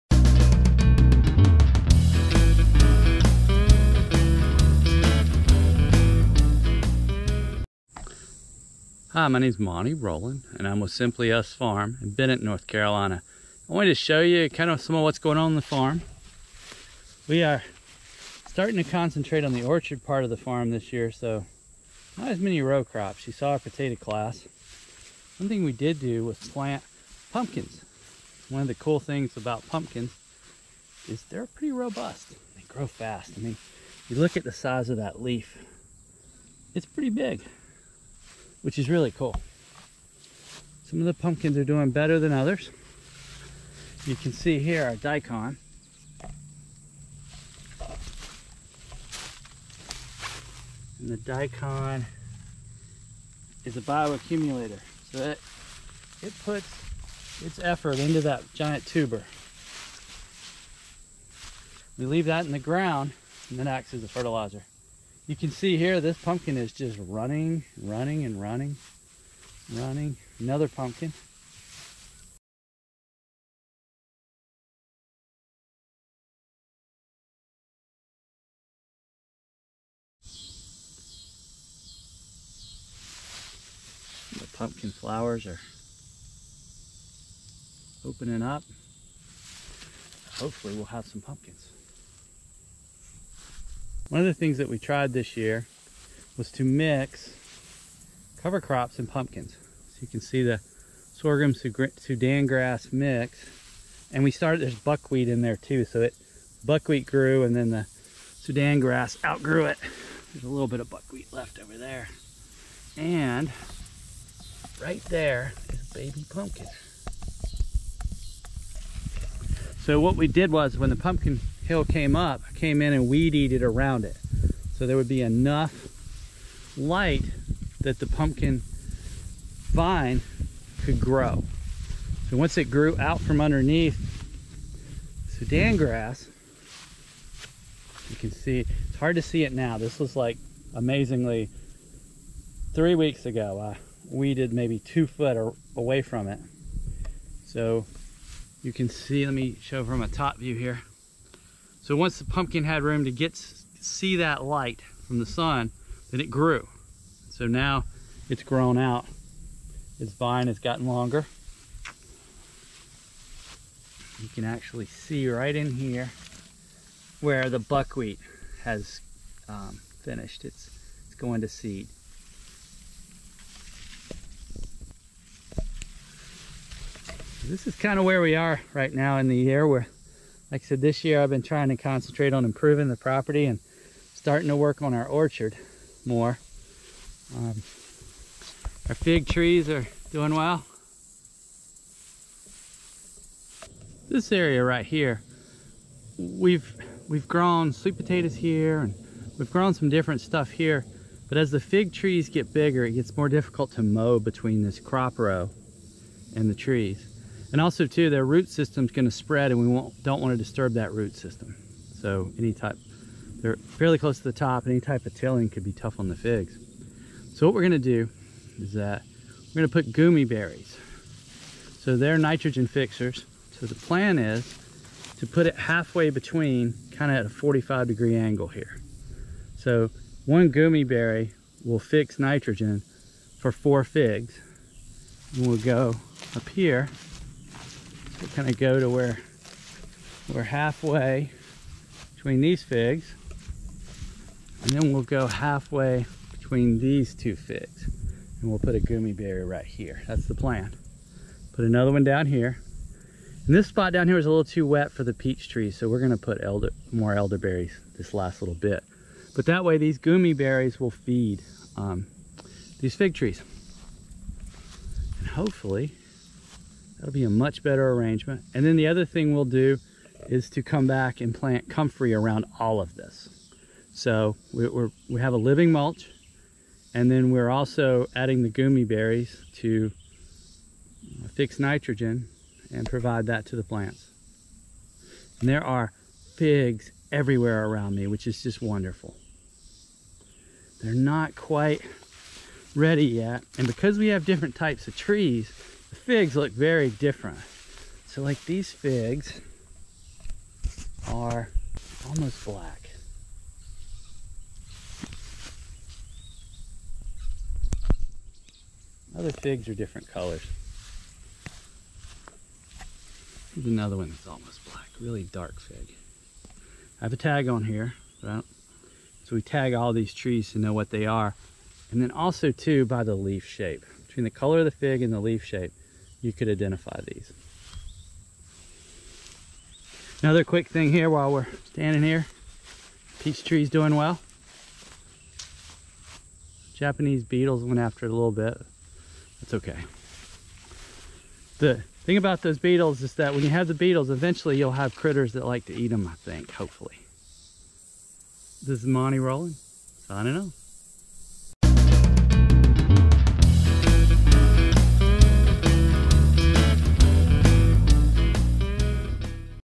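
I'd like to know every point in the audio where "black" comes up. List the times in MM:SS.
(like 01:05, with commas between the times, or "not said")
05:02, 05:14.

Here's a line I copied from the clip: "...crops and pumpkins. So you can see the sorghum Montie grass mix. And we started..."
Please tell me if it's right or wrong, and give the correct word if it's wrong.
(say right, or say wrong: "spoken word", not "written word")
wrong: "Sudan", not "Montie".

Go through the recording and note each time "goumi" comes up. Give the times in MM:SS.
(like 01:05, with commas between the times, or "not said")
03:39, 03:50, 04:08, 04:19, 04:38.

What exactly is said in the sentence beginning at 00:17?
We are starting to concentrate on the orchard part of the farm this year, so not as many row crops.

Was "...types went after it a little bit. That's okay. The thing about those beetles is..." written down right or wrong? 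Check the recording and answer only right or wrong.
wrong.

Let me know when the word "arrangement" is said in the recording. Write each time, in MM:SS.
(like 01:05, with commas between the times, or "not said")
04:27.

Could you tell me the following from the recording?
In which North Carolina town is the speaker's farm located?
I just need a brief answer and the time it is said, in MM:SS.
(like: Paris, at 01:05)
Bennett, at 00:12.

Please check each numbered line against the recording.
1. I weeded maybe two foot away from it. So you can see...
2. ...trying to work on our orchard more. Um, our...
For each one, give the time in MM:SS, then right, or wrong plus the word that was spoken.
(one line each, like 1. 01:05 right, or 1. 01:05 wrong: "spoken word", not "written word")
1. 02:23 right
2. 03:04 wrong: "starting", not "trying".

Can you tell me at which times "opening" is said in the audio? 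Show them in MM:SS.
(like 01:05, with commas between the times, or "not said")
01:28.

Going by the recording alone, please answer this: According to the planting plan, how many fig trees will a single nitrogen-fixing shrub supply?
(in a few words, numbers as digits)
4.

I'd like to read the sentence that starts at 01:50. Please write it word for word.
There's a little bit of buckwheat left over there.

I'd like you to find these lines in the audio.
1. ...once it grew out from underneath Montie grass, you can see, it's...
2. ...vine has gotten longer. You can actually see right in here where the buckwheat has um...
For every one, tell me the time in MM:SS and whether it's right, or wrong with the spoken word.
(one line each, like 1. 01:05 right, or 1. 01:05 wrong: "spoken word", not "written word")
1. 02:12 wrong: "Sudan", not "Montie"
2. 02:40 right.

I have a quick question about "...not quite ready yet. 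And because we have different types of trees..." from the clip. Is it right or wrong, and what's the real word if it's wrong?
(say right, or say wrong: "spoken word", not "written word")
right.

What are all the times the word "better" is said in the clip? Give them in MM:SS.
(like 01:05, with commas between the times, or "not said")
00:41, 04:27.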